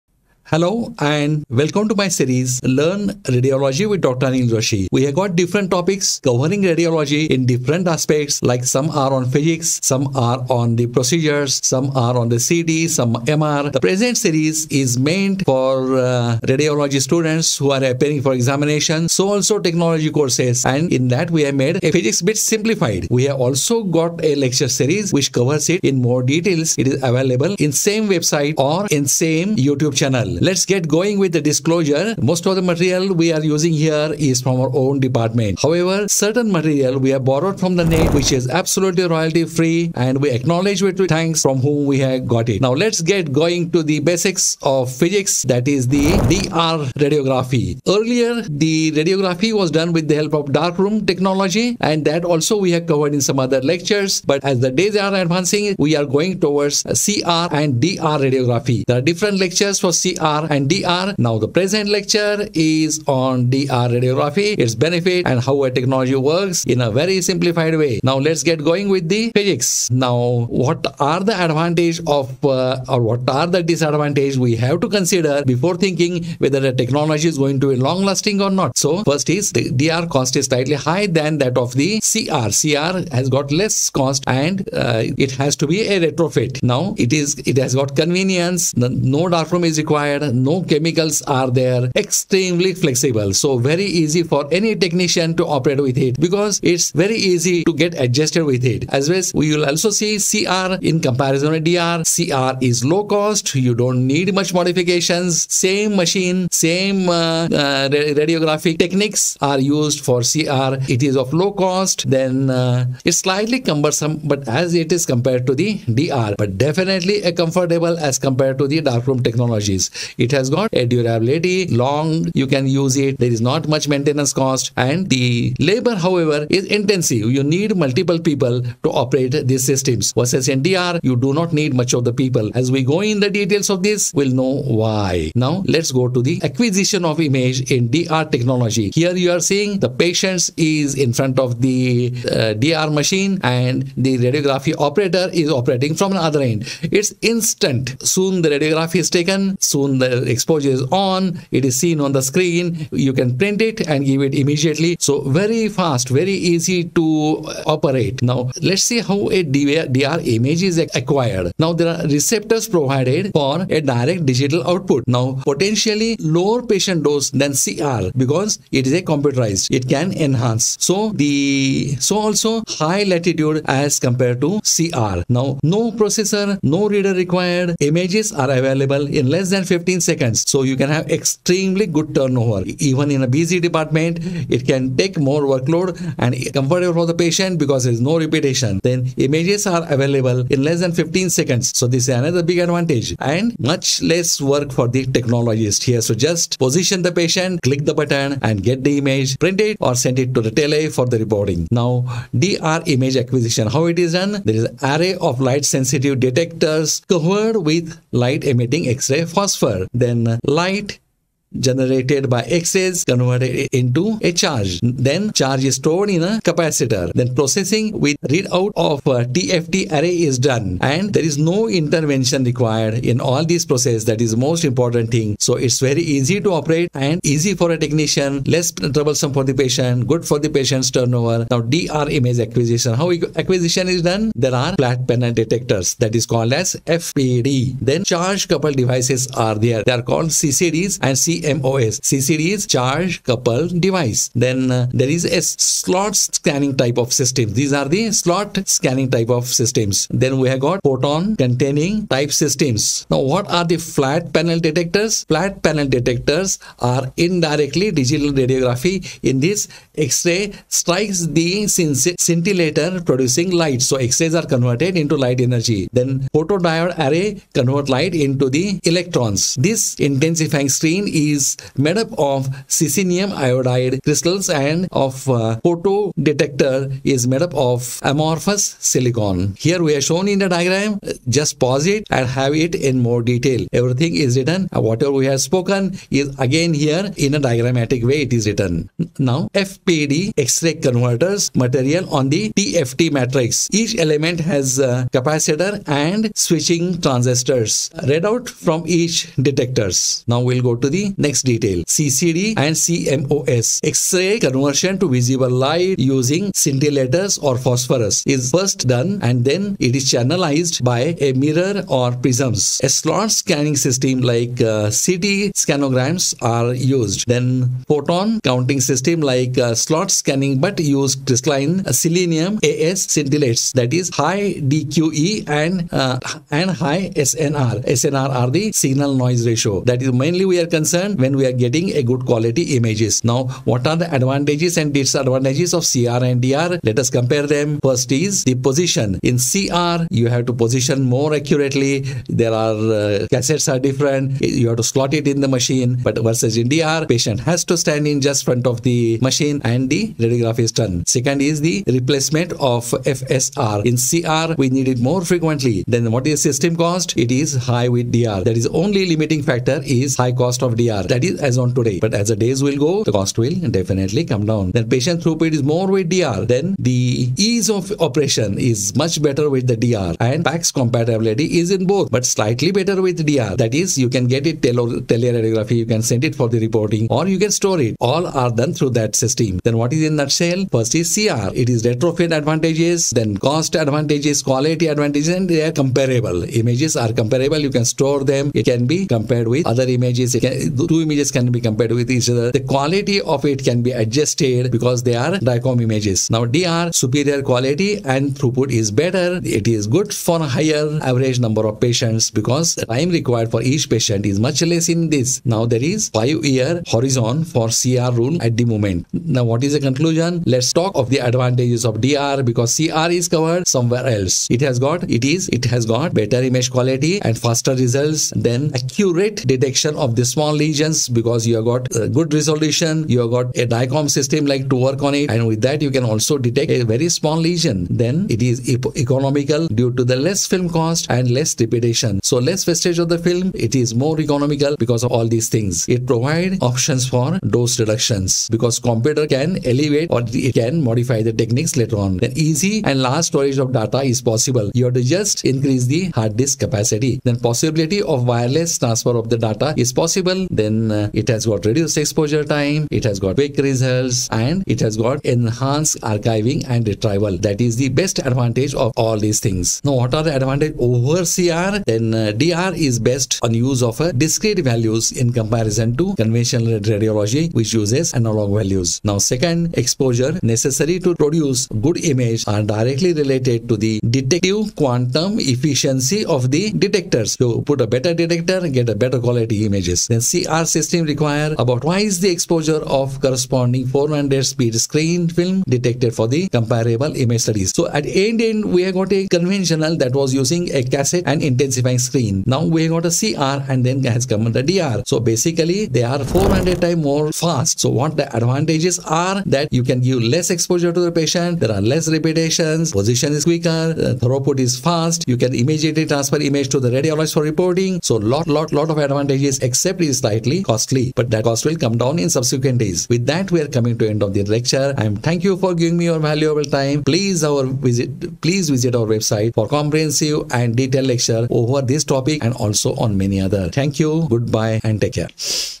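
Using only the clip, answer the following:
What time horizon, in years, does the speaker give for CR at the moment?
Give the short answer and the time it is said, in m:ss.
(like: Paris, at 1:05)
5 years, at 6:46.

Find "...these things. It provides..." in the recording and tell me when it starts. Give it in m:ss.
7:15.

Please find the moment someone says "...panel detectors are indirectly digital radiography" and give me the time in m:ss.
4:15.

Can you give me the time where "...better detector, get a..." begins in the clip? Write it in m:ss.
7:57.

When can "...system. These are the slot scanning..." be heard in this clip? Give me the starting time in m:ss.
4:07.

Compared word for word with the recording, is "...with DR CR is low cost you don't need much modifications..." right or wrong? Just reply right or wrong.
right.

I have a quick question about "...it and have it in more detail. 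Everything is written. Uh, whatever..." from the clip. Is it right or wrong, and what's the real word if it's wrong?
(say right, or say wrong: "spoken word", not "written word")
right.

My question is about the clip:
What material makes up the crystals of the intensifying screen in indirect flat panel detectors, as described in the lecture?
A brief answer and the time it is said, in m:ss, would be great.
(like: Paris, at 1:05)
Cesium iodide, at 4:32.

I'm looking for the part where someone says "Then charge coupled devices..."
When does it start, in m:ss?
3:57.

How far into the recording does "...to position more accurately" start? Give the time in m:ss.
5:40.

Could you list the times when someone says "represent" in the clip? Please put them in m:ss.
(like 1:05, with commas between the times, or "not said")
not said.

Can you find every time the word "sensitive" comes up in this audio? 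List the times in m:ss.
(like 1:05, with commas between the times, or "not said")
3:25.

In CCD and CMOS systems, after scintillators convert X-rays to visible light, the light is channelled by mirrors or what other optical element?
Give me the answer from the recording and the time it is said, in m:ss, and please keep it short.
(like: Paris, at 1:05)
Prisms, at 5:12.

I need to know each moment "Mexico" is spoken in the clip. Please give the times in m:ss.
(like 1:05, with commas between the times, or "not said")
not said.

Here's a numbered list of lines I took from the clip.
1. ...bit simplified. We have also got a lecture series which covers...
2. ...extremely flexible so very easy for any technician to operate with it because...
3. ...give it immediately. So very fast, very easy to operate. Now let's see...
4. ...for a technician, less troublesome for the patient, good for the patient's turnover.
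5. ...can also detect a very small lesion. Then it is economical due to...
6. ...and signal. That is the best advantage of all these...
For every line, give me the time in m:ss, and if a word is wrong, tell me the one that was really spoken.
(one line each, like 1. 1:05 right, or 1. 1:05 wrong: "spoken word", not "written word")
1. 0:22 right
2. 1:31 right
3. 2:34 right
4. 3:47 right
5. 7:05 right
6. 7:36 wrong: "retrieval", not "signal".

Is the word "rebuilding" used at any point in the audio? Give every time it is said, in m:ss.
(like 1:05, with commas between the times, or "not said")
not said.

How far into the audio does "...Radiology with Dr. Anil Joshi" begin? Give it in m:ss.
0:03.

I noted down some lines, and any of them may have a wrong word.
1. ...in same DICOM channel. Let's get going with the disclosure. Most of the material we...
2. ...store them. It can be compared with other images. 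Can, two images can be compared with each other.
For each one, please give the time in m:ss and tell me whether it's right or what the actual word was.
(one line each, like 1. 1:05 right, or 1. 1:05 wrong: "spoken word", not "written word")
1. 0:28 wrong: "YouTube", not "DICOM"
2. 6:27 right.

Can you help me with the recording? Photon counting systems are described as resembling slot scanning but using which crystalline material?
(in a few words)
Crystalline selenium.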